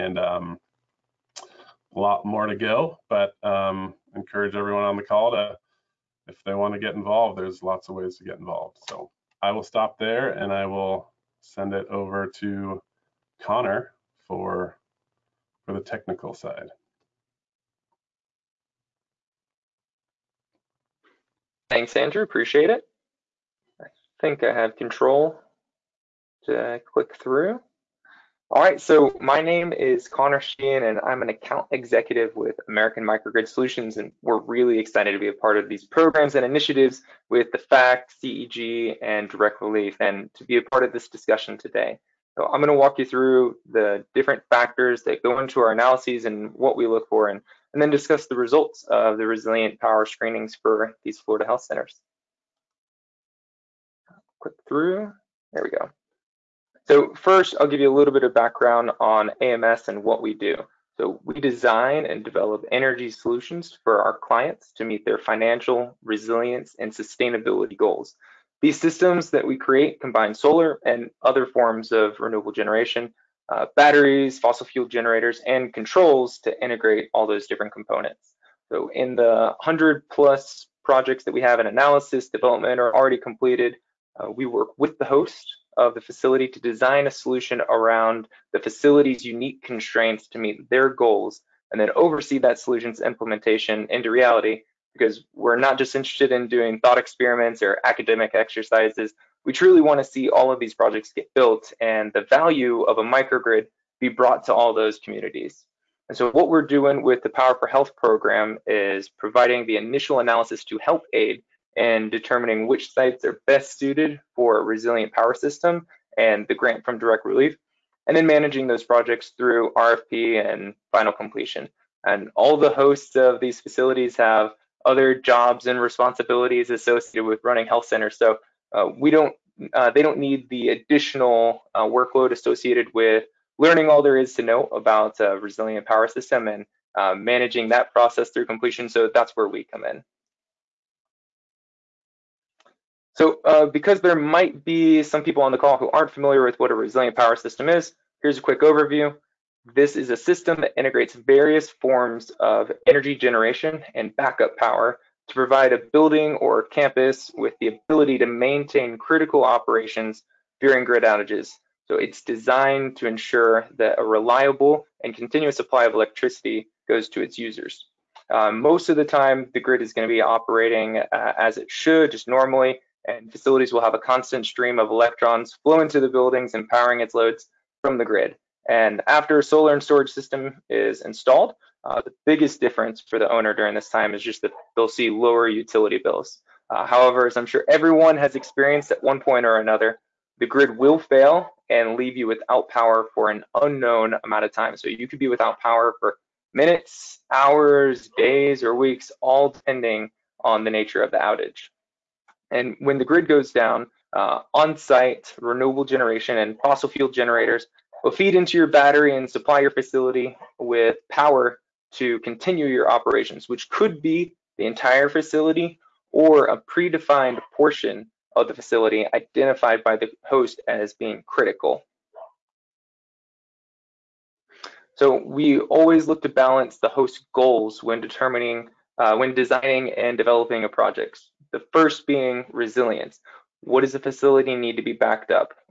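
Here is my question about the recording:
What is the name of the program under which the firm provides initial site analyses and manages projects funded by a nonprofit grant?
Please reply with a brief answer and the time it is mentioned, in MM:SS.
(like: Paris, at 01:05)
Power for Health, at 01:47.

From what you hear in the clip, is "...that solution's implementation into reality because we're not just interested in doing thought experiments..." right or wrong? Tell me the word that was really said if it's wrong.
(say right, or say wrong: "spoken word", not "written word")
right.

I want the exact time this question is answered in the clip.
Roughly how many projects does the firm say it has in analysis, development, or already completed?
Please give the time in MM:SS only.
01:19.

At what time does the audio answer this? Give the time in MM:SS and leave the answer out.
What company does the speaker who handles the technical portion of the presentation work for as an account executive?
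00:32.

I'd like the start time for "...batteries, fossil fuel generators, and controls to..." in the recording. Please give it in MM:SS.
01:13.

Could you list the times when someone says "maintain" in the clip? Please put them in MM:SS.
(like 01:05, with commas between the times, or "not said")
02:38.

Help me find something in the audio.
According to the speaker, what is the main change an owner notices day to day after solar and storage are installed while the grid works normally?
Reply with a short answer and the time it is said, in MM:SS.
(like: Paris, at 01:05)
lower utility bills, at 03:05.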